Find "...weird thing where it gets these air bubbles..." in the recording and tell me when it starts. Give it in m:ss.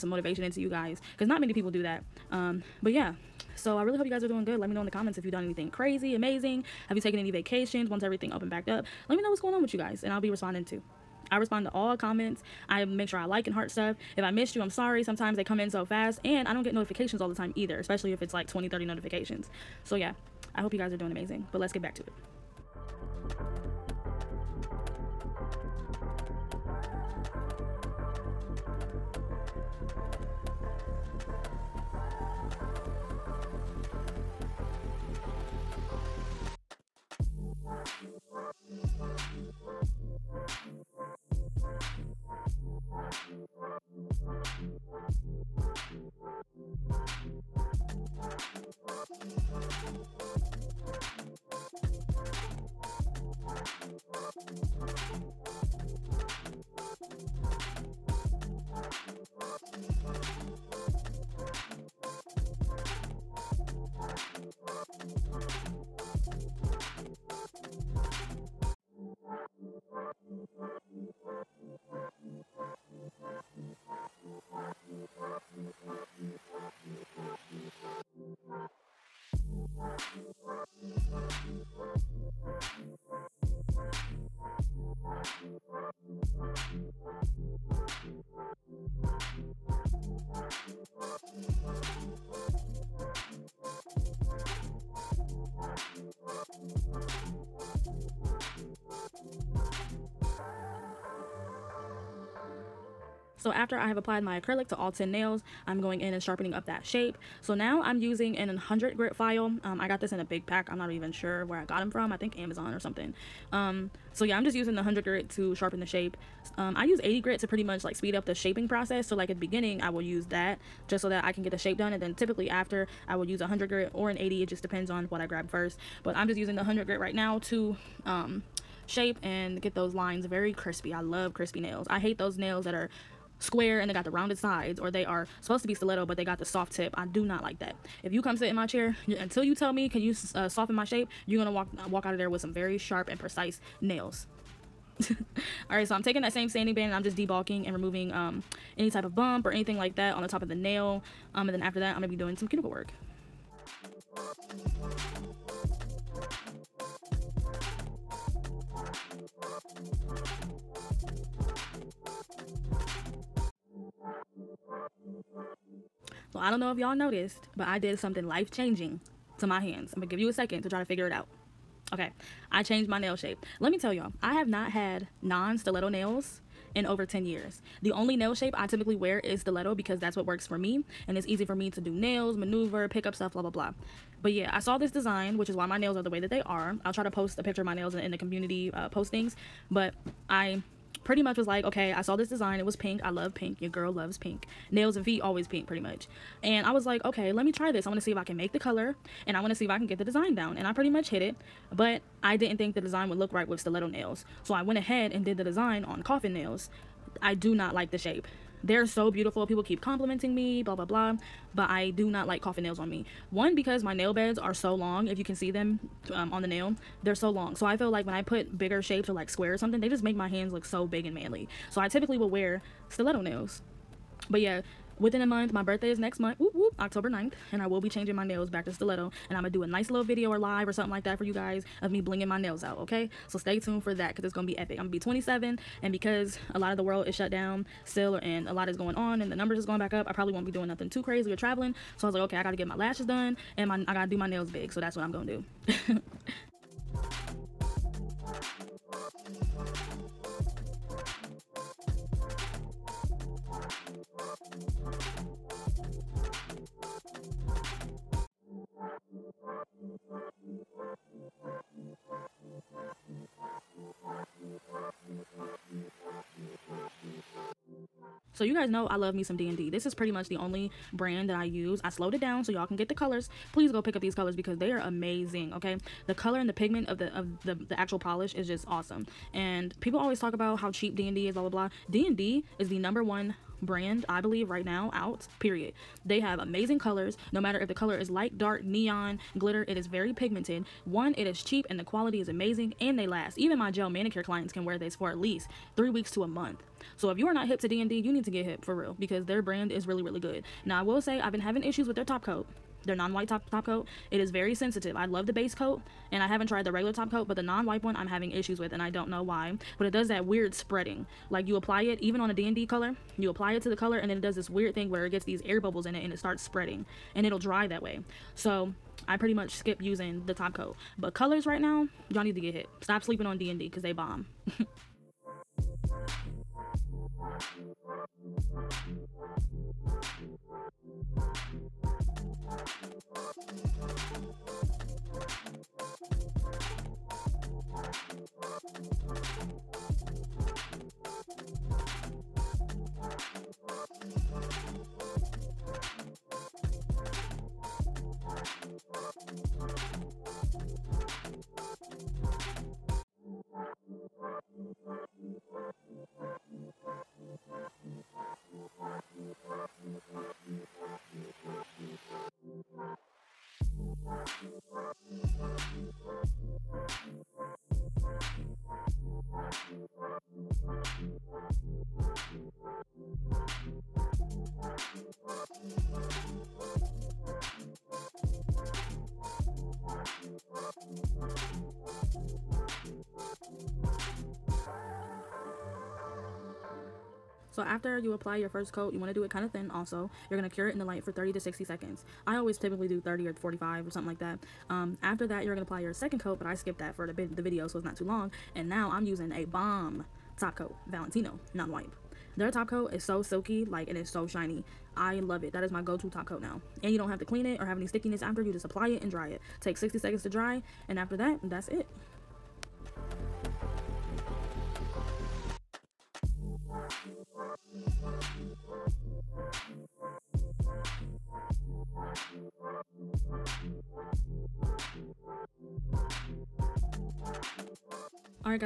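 5:14.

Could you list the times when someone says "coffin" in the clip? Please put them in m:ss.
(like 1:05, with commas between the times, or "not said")
3:26, 3:32.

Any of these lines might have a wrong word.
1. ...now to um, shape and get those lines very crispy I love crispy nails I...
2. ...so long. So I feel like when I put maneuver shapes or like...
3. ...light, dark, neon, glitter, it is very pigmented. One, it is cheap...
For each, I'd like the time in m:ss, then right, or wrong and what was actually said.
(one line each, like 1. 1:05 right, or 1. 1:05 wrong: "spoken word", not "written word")
1. 2:07 right
2. 3:37 wrong: "bigger", not "maneuver"
3. 4:48 right.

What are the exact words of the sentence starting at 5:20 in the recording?
But colors right now, Y'all need to get hit.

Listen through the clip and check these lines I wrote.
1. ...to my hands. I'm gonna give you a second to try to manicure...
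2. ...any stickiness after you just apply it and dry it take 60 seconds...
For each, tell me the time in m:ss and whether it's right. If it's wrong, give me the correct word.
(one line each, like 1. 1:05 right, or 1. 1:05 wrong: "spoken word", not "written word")
1. 2:49 wrong: "figure", not "manicure"
2. 6:47 right.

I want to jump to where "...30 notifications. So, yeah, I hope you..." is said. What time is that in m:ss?
0:18.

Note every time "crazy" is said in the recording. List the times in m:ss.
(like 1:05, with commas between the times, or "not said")
0:05, 4:01.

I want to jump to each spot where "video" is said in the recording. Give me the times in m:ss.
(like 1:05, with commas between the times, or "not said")
3:50, 6:37.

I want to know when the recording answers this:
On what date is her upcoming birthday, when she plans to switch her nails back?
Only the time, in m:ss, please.
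3:46.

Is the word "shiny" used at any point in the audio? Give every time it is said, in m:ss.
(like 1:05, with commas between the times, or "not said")
6:44.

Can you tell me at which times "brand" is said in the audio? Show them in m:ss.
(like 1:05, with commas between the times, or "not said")
4:30, 4:43, 4:59.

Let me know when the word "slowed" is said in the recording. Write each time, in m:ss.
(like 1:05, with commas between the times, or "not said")
4:31.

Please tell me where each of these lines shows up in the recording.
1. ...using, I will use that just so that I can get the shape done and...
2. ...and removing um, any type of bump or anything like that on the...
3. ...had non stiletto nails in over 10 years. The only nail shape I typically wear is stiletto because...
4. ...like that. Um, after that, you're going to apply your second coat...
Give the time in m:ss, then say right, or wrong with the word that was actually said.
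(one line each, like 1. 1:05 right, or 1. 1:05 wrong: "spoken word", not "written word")
1. 1:59 wrong: "beginning", not "using"
2. 2:27 right
3. 2:54 right
4. 6:34 right.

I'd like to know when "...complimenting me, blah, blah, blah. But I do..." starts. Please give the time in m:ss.
3:29.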